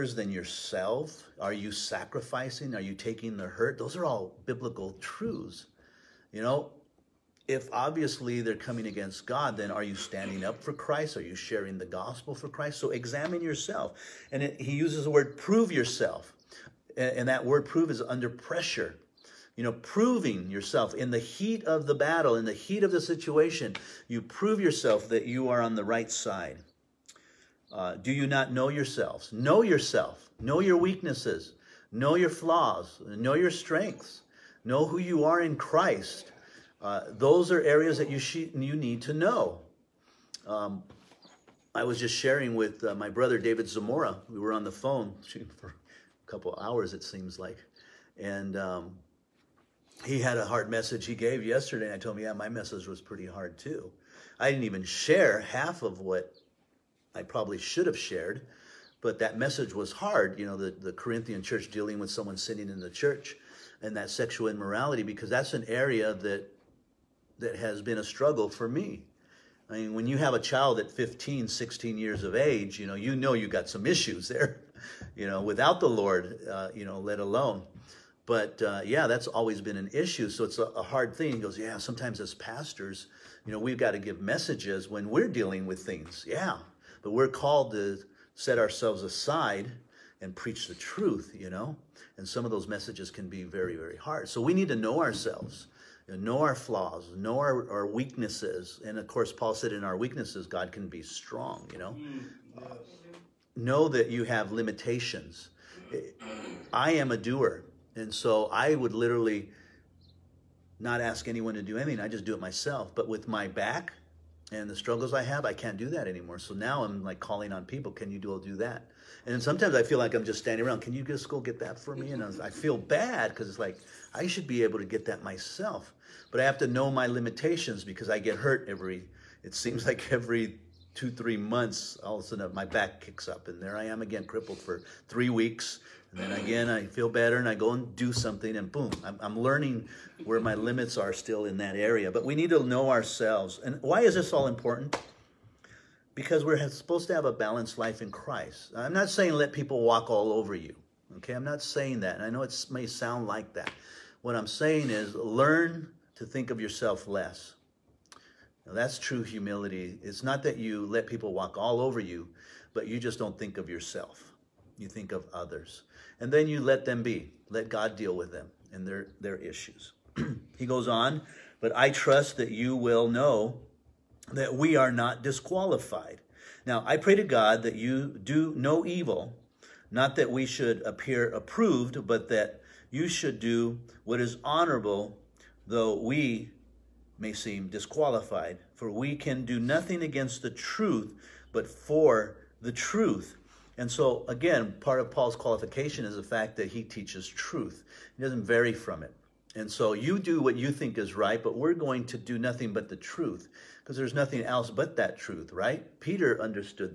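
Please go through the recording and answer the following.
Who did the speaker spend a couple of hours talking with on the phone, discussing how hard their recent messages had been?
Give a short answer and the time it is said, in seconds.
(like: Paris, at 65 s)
David Zamora, at 43 s.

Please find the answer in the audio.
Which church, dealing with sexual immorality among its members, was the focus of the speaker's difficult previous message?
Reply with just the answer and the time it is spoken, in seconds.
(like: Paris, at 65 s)
Corinthian church, at 60 s.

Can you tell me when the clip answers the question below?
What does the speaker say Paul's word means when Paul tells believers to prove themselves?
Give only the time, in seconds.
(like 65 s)
18 s.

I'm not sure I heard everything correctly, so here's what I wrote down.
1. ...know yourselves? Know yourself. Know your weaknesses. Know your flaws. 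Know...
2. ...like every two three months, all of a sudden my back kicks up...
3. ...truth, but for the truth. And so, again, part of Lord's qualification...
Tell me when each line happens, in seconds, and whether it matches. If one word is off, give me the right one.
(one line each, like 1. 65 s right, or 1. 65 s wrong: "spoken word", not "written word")
1. 28 s right
2. 129 s right
3. 190 s wrong: "Paul", not "Lord".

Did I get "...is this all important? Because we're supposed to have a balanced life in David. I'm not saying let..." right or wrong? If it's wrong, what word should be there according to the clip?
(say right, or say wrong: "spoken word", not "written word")
wrong: "Christ", not "David".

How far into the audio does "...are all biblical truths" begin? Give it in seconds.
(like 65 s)
3 s.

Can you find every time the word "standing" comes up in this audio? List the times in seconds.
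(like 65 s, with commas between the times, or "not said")
9 s, 120 s.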